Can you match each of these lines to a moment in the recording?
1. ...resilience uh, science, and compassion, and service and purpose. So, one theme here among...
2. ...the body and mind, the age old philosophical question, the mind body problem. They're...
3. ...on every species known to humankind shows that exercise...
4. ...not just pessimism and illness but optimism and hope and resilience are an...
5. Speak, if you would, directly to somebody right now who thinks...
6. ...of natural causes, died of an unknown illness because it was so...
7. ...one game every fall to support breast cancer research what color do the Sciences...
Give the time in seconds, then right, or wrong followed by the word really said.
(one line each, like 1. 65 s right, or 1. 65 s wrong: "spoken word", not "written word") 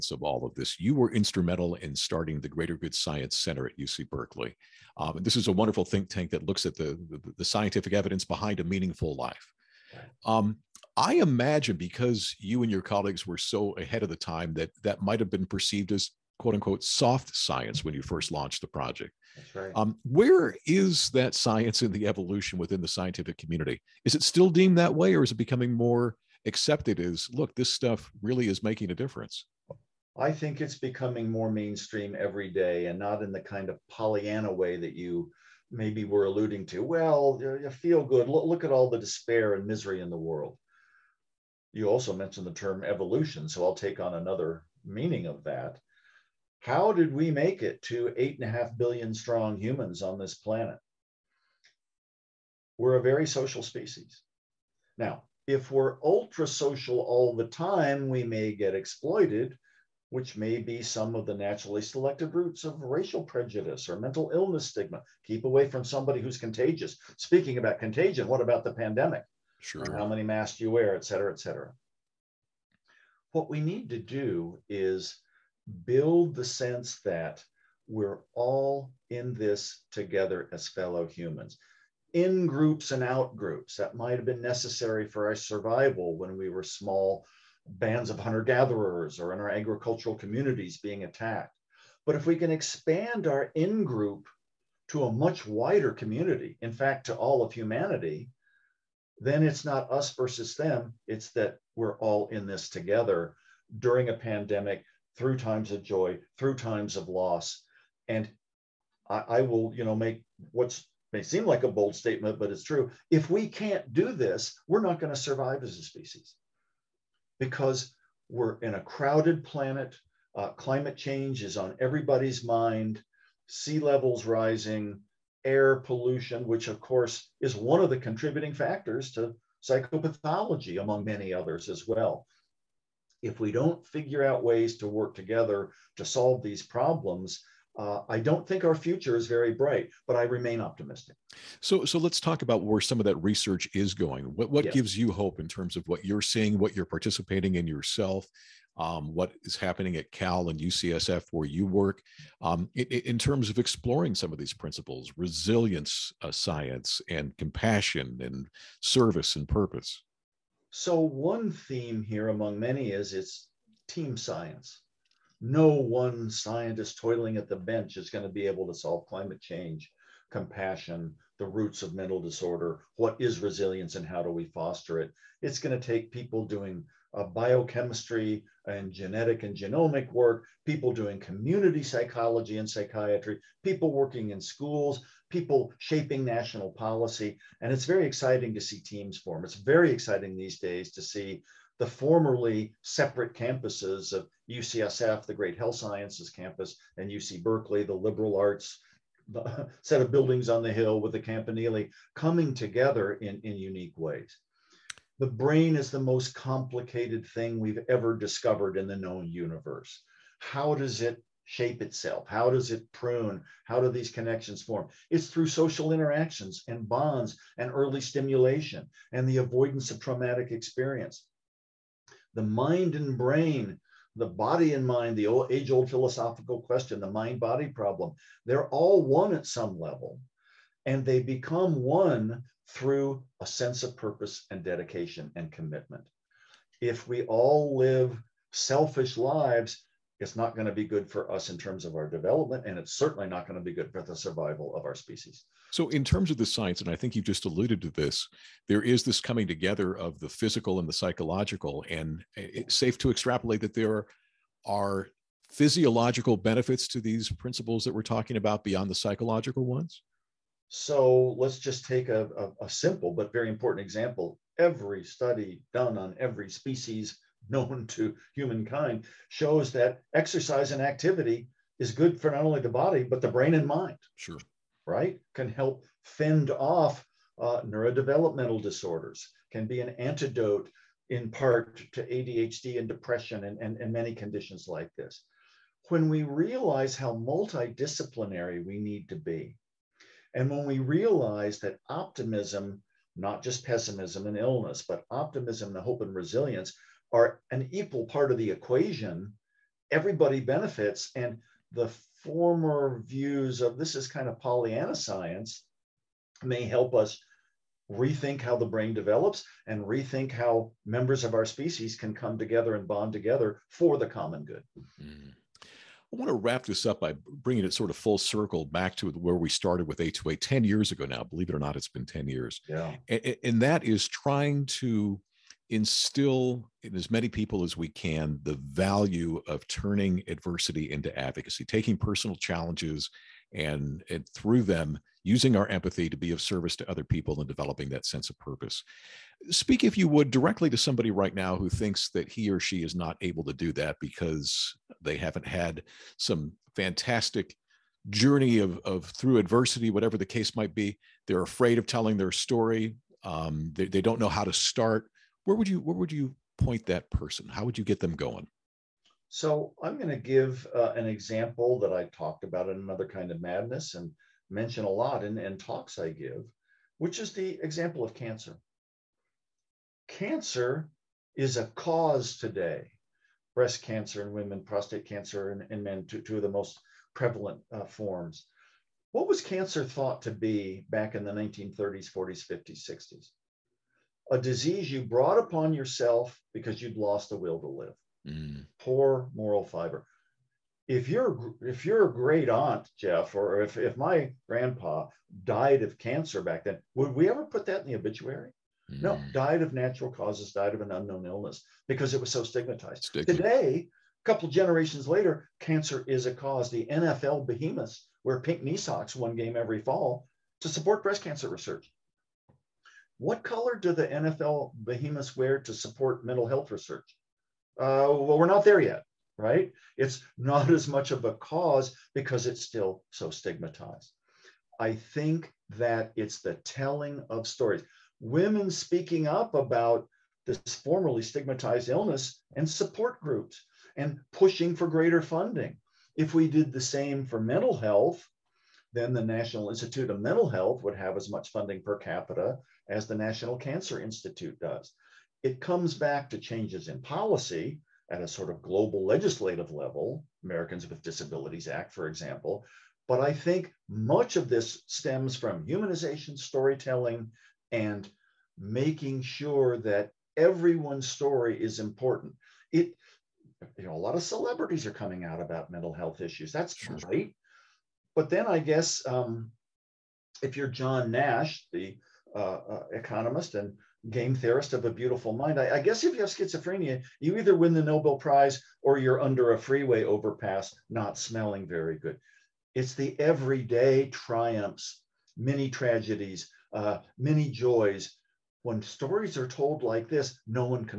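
1. 155 s right
2. 224 s right
3. 265 s right
4. 293 s right
5. 339 s right
6. 399 s right
7. 409 s wrong: "NFL", not "Sciences".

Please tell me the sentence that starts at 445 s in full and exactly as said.
It comes back to changes in policy at a sort of global legislative level, Americans with Disabilities Act, for example.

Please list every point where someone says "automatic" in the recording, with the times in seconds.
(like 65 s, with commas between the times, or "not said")
not said.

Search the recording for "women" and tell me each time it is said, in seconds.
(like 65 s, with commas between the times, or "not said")
374 s, 428 s.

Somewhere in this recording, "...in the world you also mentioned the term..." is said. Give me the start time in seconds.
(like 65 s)
40 s.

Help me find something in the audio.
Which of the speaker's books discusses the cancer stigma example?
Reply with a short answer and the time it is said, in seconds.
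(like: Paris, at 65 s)
Another Kind of Madness, at 362 s.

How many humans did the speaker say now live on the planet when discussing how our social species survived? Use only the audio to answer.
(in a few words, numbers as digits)
8.5 billion.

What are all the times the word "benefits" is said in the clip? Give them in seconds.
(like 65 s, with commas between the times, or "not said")
256 s, 300 s.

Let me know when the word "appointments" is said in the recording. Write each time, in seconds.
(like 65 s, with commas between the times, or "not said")
not said.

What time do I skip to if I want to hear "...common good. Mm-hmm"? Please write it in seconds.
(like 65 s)
314 s.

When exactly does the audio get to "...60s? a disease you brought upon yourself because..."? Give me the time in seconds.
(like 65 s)
382 s.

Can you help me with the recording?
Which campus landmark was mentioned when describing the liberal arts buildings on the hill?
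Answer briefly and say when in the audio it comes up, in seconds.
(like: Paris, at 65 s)
campanile, at 201 s.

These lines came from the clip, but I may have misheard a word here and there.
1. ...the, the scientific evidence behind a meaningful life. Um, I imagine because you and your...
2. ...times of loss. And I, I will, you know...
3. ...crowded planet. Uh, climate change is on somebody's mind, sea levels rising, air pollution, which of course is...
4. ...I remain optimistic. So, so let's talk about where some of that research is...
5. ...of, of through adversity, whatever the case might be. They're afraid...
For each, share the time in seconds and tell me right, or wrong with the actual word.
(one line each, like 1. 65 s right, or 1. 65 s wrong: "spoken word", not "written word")
1. 7 s right
2. 106 s right
3. 118 s wrong: "everybody", not "somebody"
4. 140 s right
5. 348 s right.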